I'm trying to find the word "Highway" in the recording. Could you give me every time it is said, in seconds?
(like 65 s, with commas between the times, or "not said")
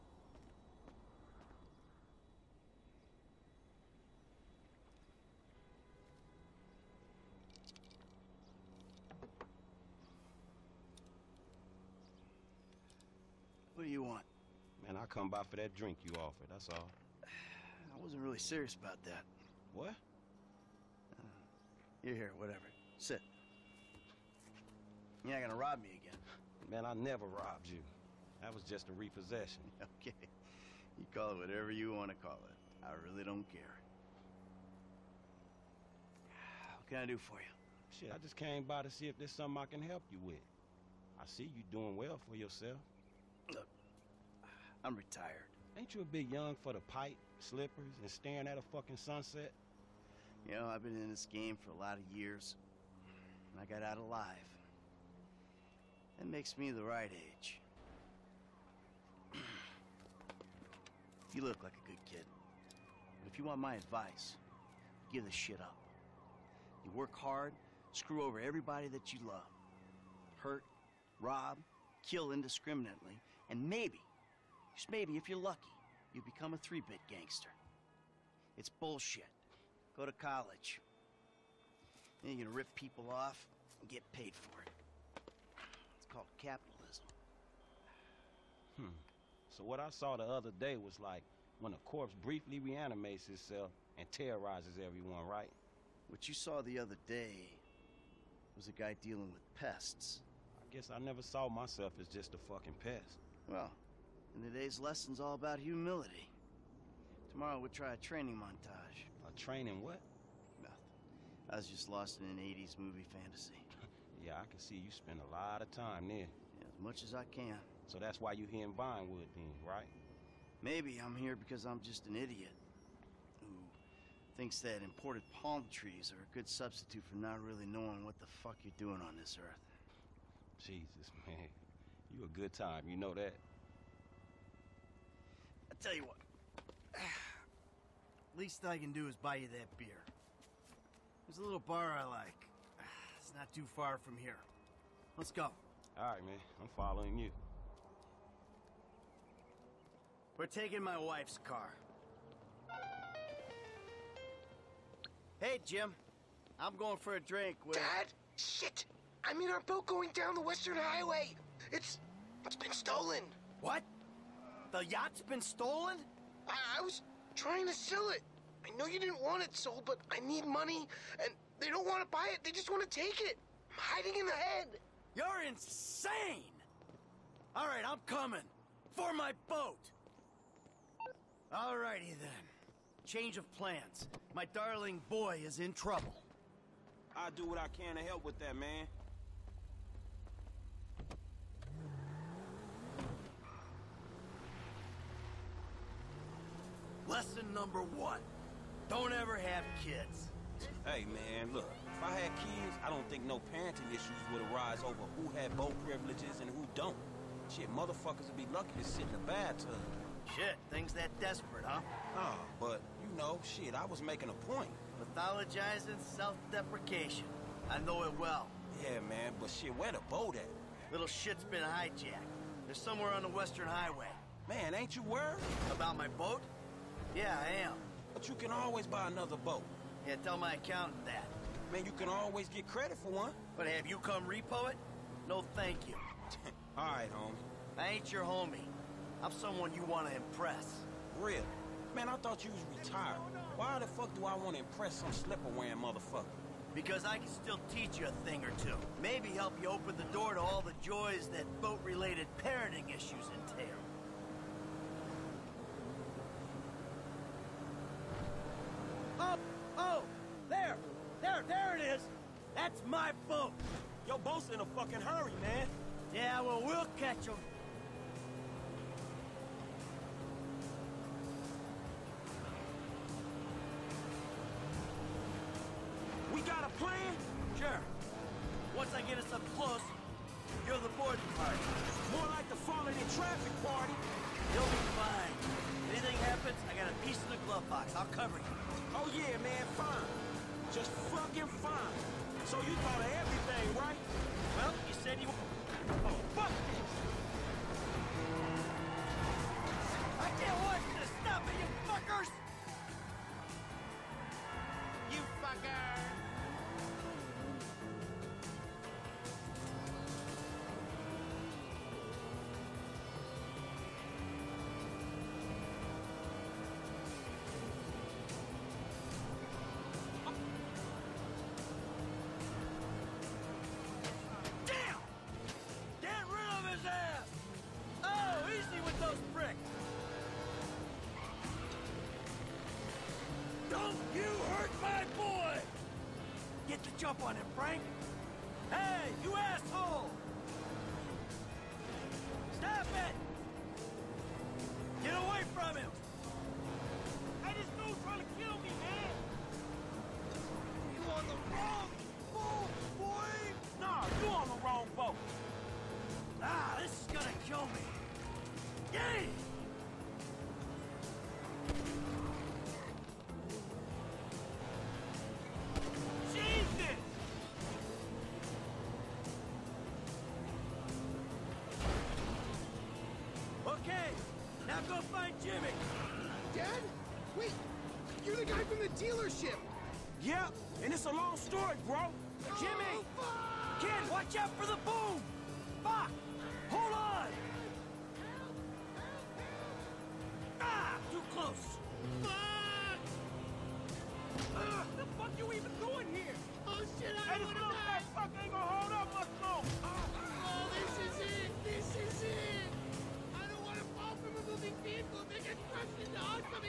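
160 s, 223 s.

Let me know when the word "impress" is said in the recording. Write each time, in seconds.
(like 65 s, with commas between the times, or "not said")
240 s, 244 s.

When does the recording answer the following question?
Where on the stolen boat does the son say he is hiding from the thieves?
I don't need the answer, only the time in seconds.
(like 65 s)
174 s.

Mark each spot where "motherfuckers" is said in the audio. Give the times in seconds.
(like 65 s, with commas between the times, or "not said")
207 s, 245 s.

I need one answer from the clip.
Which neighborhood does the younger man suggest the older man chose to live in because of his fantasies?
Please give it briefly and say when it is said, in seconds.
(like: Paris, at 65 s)
Vinewood, at 118 s.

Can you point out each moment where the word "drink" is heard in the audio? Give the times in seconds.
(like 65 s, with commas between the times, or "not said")
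15 s, 157 s.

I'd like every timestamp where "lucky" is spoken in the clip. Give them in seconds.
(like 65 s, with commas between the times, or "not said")
75 s, 208 s.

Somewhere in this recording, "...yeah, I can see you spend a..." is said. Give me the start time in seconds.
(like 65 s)
114 s.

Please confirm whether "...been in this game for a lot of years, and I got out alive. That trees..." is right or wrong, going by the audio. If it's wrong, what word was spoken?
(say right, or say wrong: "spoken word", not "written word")
wrong: "makes", not "trees".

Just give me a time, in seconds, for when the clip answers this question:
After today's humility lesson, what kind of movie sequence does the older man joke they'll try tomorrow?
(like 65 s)
107 s.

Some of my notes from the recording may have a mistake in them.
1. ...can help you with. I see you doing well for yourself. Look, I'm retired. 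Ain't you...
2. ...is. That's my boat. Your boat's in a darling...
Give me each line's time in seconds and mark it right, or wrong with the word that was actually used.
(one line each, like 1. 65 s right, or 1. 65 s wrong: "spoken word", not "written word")
1. 39 s right
2. 261 s wrong: "fucking", not "darling".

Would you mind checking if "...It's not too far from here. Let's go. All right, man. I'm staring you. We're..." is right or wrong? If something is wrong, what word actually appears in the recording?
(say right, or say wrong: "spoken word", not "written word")
wrong: "following", not "staring".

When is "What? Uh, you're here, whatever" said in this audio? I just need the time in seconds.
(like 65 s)
19 s.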